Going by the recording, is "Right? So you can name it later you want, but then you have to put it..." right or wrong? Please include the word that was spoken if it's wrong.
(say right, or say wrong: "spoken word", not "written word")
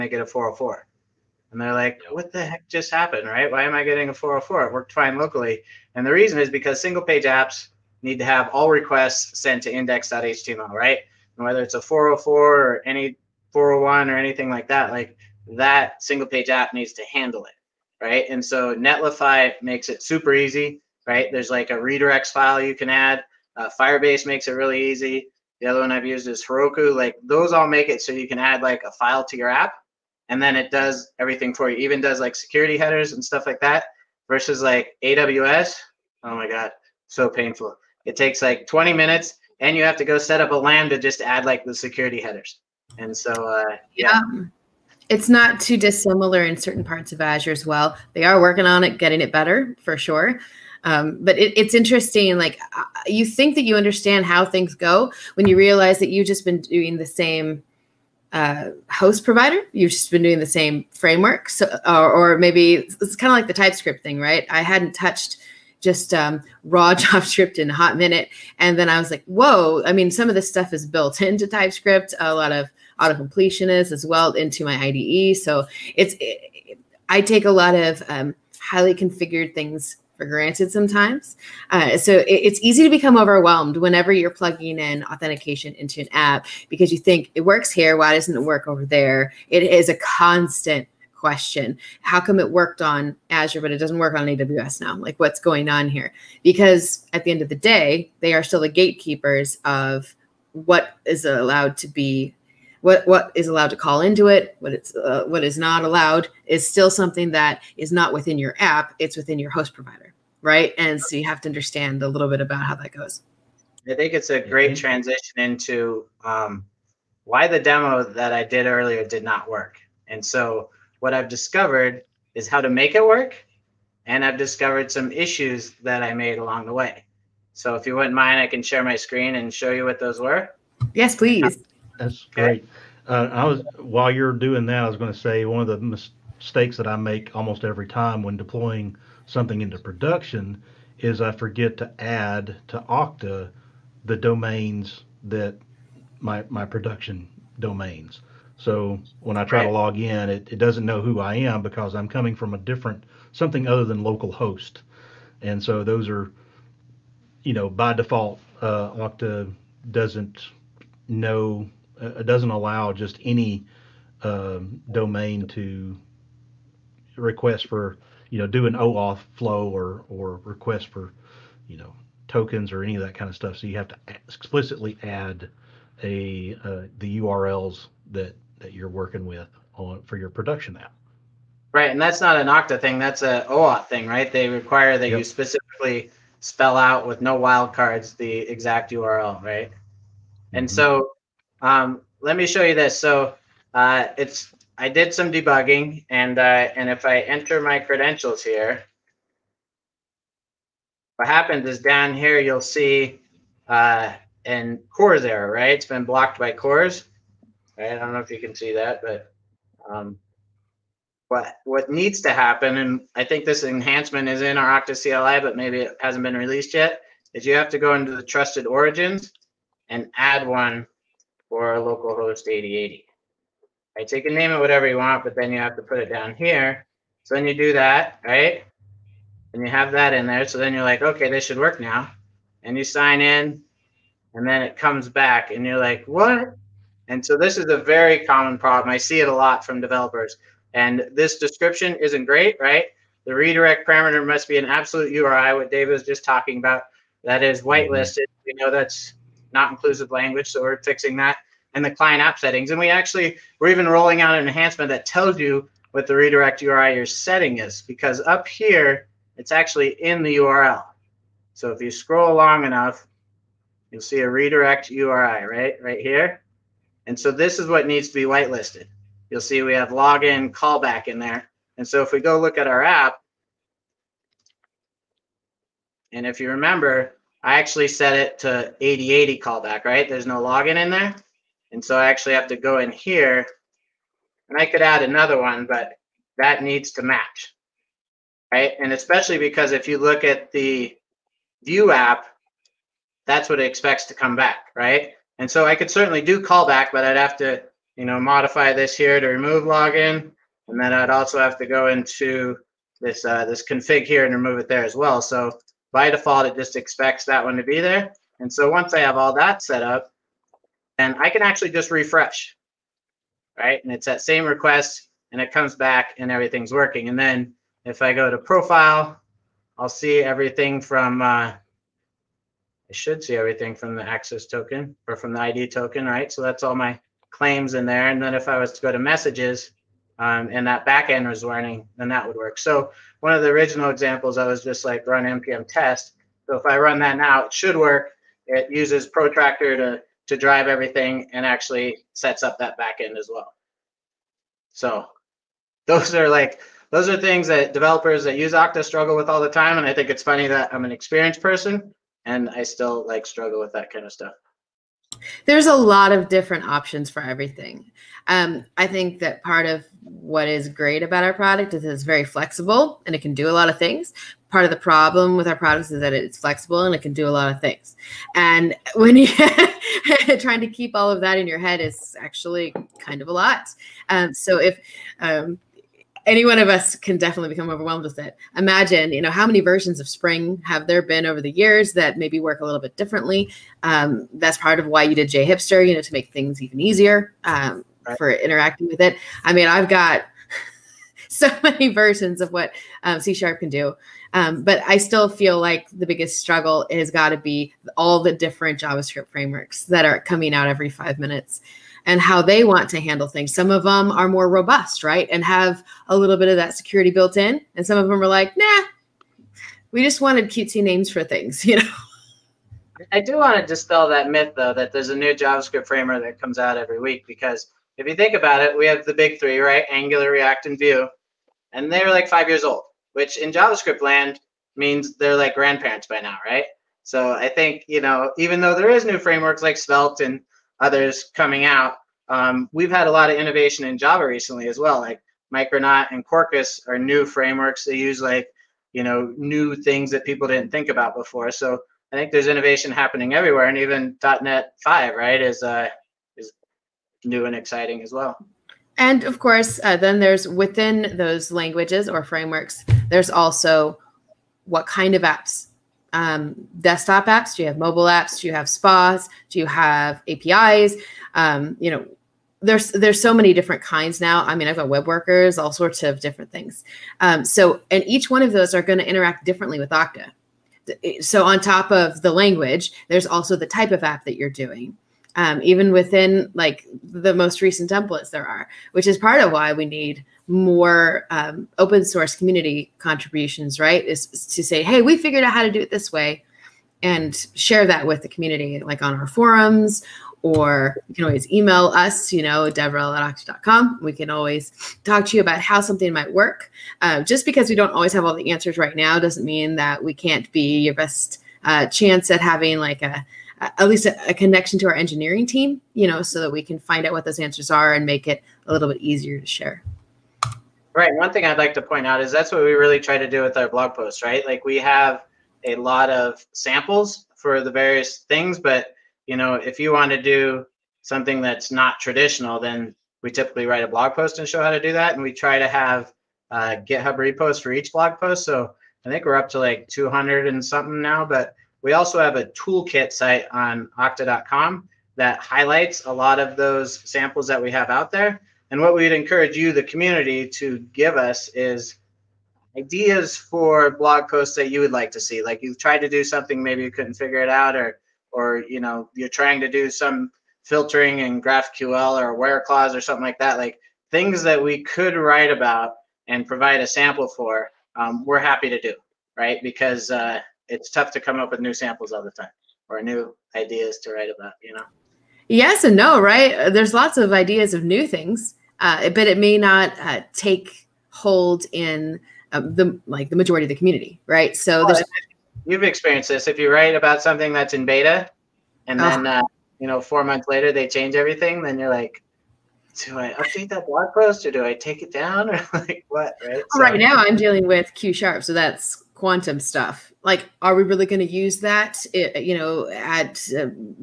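wrong: "whatever", not "later".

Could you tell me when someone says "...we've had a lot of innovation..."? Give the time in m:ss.
7:12.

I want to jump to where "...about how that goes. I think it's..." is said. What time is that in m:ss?
1:52.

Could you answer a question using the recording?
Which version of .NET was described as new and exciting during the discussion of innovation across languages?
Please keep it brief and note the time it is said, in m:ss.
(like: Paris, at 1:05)
.NET 5, at 7:24.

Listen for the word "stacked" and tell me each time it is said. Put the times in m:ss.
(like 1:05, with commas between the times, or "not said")
not said.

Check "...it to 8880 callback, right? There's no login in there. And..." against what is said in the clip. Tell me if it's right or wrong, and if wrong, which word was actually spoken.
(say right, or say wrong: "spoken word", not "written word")
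wrong: "8080", not "8880".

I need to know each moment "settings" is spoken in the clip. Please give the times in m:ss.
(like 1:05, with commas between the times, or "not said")
4:12, 4:17.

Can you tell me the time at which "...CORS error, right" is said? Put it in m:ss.
3:24.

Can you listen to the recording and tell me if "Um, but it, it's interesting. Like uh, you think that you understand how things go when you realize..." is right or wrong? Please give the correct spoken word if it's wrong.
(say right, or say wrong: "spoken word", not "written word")
right.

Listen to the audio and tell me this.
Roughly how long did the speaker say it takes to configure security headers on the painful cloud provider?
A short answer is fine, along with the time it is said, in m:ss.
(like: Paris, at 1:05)
20 minutes, at 0:38.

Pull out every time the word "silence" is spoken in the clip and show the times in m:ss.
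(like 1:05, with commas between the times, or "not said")
not said.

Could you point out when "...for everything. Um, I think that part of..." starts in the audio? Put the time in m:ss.
5:57.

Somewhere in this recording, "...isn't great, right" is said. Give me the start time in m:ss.
4:01.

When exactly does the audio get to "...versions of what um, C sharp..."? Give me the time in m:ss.
6:31.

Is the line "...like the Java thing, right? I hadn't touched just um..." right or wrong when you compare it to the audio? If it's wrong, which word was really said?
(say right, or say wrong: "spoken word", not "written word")
wrong: "TypeScript", not "Java".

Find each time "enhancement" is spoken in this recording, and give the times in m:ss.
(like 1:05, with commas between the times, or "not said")
3:33, 4:14.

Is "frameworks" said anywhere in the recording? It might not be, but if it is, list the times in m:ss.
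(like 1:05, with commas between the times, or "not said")
1:00, 6:39, 6:55, 7:09, 7:17, 7:32.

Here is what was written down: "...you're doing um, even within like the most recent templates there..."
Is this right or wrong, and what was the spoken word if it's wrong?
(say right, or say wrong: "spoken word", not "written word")
right.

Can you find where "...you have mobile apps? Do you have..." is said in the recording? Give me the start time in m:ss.
7:37.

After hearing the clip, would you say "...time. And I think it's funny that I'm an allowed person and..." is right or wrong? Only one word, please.
wrong.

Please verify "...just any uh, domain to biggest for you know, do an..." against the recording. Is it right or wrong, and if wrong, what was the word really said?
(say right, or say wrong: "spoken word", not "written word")
wrong: "request", not "biggest".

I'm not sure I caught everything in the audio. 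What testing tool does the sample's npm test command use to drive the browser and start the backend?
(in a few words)
Protractor.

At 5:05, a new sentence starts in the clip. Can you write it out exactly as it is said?
So by default, it just expects that one to be there.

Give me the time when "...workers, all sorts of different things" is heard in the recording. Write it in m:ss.
7:45.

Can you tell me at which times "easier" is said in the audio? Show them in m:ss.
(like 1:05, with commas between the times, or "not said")
6:26, 8:29.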